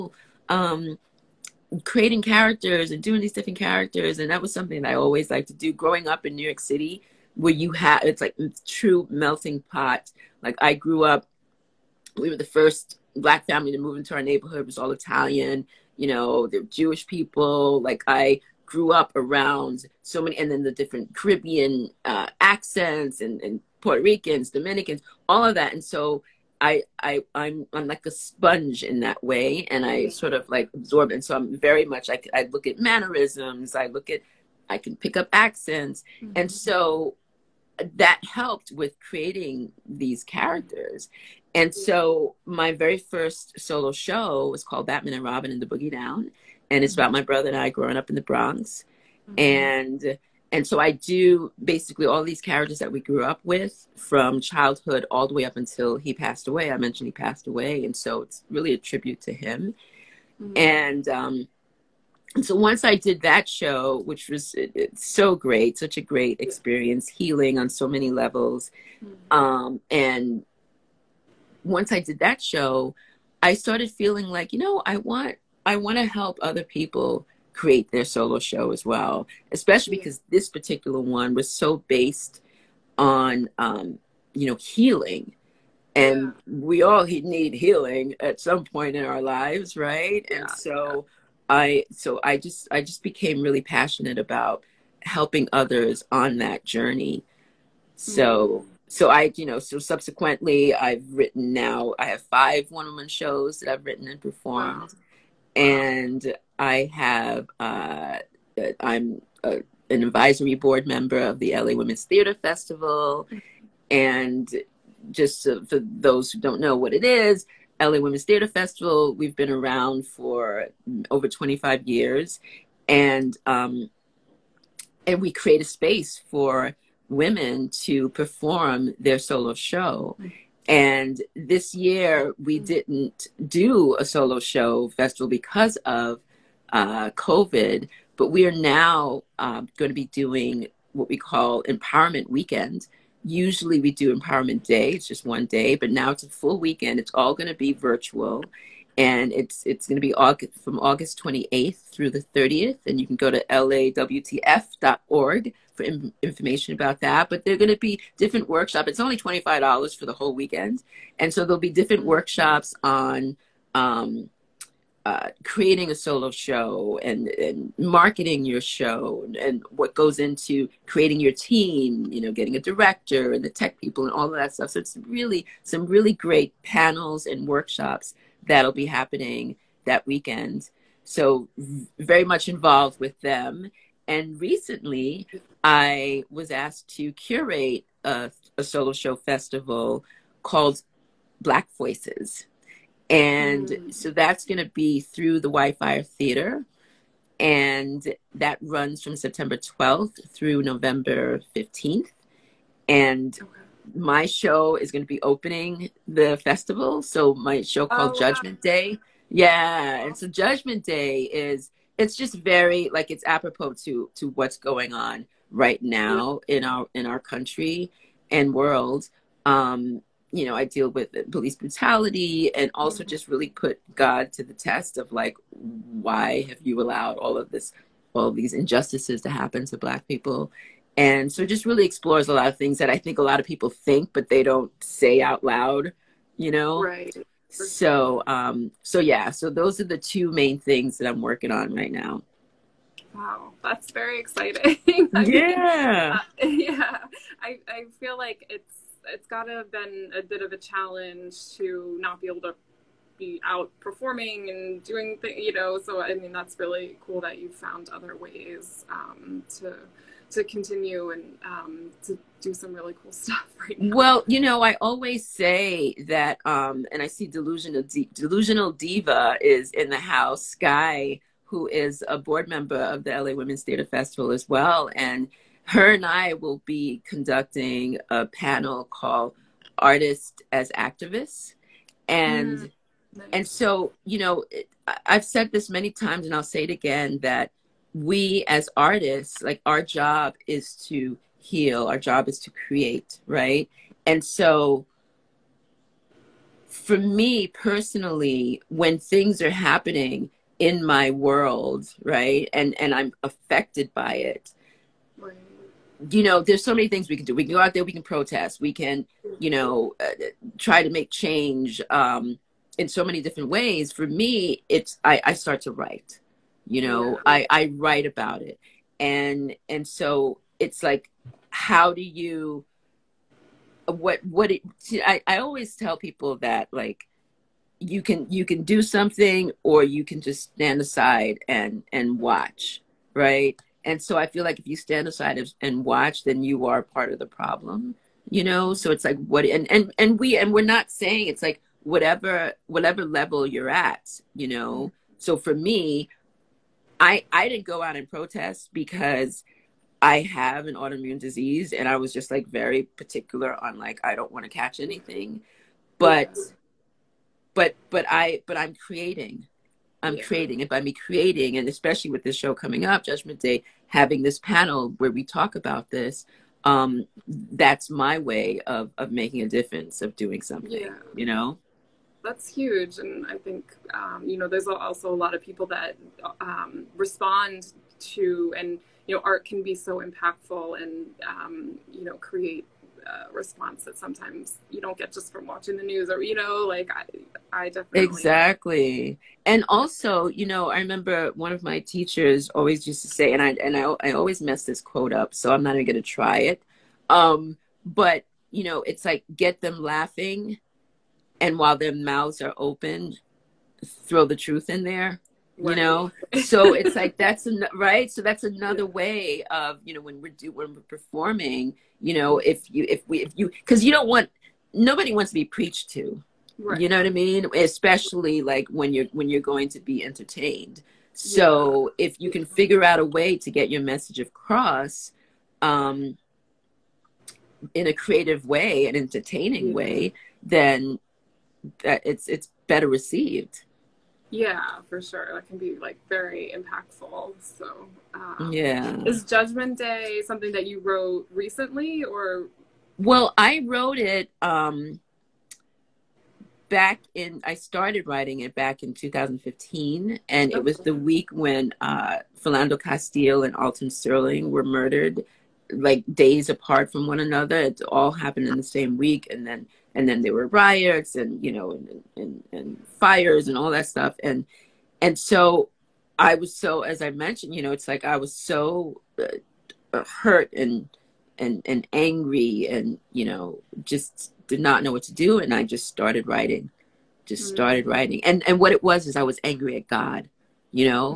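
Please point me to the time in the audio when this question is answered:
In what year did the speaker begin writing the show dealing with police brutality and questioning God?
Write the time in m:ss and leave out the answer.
7:28.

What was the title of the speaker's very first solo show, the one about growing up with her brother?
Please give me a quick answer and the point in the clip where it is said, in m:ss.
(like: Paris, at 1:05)
Batman and Robin in the Boogie Down, at 0:44.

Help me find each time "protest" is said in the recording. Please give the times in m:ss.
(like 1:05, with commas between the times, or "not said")
5:08, 5:48.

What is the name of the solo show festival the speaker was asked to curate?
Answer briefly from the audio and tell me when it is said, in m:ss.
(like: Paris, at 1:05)
Black Voices, at 3:11.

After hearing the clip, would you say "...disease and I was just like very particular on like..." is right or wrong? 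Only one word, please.
right.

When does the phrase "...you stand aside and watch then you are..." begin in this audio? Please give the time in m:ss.
5:34.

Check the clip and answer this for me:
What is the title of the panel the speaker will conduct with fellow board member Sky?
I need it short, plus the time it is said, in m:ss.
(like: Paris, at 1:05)
Artists as Activists, at 4:39.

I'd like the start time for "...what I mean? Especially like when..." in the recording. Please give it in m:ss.
6:56.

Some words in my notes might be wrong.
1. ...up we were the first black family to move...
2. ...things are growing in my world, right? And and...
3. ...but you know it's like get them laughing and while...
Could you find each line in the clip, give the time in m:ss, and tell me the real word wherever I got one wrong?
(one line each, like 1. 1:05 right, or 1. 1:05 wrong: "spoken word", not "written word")
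1. 0:11 right
2. 4:58 wrong: "happening", not "growing"
3. 6:37 right.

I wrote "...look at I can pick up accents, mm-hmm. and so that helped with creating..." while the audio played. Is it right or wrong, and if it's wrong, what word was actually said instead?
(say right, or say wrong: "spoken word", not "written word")
right.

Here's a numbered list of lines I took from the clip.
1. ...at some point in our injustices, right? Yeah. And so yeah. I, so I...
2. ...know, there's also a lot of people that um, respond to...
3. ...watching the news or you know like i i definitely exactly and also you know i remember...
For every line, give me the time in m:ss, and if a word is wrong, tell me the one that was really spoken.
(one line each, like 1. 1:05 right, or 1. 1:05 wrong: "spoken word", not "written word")
1. 1:28 wrong: "lives", not "injustices"
2. 6:14 right
3. 6:25 right.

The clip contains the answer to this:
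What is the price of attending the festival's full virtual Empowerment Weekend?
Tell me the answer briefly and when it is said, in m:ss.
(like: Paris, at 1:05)
$25, at 2:39.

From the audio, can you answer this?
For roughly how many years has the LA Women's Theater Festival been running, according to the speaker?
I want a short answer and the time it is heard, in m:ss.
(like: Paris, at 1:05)
over 25, at 2:01.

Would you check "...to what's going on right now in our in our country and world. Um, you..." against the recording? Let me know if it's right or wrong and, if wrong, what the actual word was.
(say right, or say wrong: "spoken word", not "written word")
right.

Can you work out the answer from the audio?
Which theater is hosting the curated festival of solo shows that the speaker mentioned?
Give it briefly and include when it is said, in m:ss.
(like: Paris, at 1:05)
Whitefire Theater, at 3:15.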